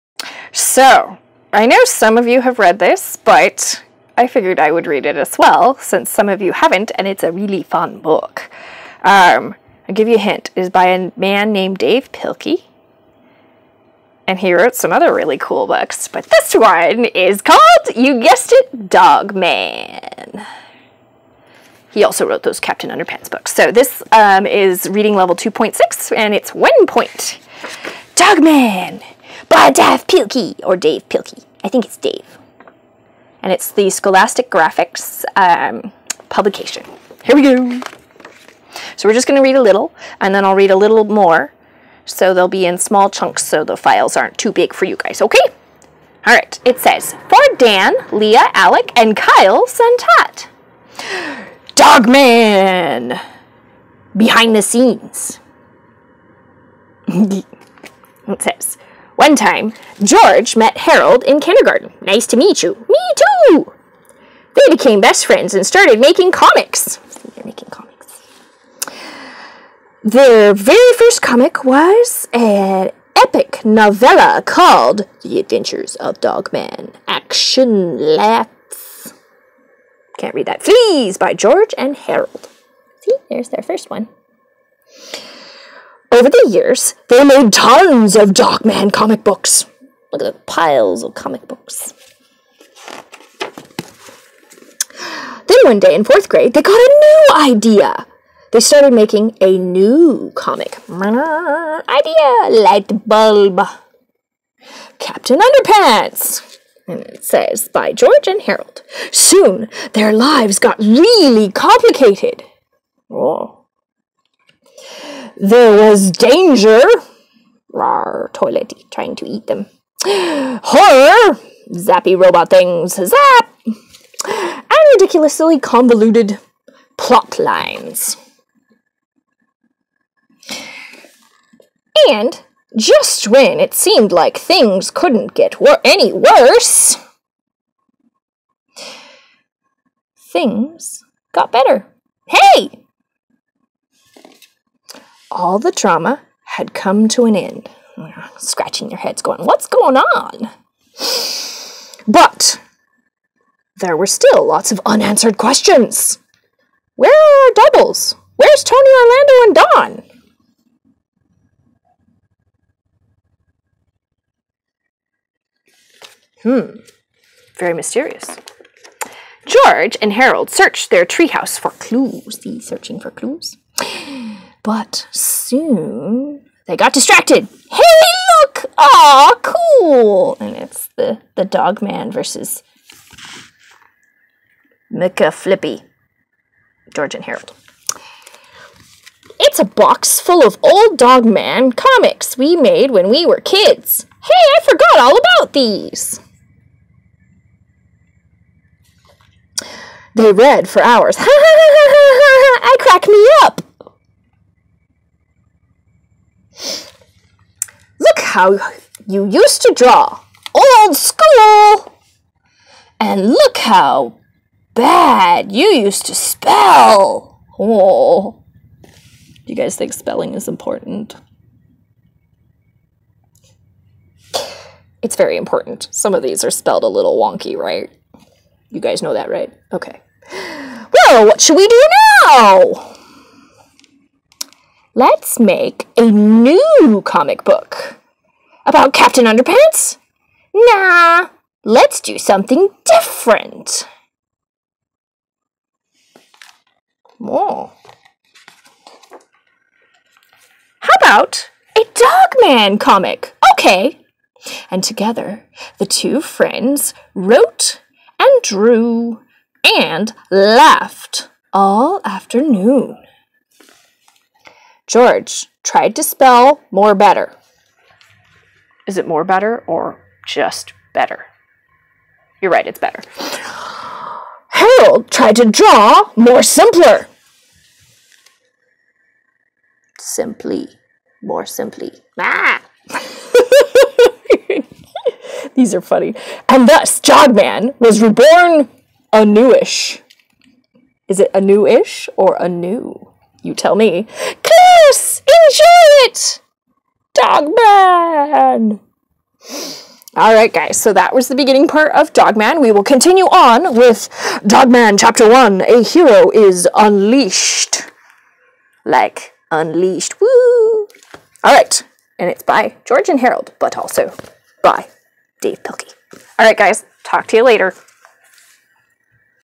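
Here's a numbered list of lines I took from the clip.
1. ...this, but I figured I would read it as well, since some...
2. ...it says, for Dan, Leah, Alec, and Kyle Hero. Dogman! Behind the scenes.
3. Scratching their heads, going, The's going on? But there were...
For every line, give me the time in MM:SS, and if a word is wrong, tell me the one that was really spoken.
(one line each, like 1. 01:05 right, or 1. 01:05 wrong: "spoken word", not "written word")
1. 00:02 right
2. 00:46 wrong: "Santat", not "Hero"
3. 02:28 wrong: "What", not "The".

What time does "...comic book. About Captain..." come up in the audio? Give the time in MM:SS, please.
03:57.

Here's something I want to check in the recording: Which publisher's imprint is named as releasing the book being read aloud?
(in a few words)
Scholastic Graphix.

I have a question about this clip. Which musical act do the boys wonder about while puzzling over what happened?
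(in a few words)
Tony Orlando and Dawn.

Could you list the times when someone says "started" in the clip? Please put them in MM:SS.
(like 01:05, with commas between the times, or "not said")
01:05, 01:38.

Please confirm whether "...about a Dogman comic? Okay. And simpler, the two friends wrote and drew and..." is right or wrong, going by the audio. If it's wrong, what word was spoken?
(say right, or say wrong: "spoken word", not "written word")
wrong: "together", not "simpler".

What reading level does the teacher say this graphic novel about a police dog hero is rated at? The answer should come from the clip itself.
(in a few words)
2.6.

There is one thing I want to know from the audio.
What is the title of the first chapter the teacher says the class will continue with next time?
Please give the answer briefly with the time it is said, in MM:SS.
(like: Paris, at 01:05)
A Hero is Unleashed, at 05:05.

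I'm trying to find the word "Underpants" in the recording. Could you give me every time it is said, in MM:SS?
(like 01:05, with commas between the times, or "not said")
00:22, 01:45, 03:59.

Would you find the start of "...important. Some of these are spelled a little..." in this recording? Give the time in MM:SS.
03:45.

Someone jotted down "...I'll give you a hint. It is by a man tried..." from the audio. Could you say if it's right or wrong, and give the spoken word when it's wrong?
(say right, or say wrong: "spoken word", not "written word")
wrong: "named", not "tried".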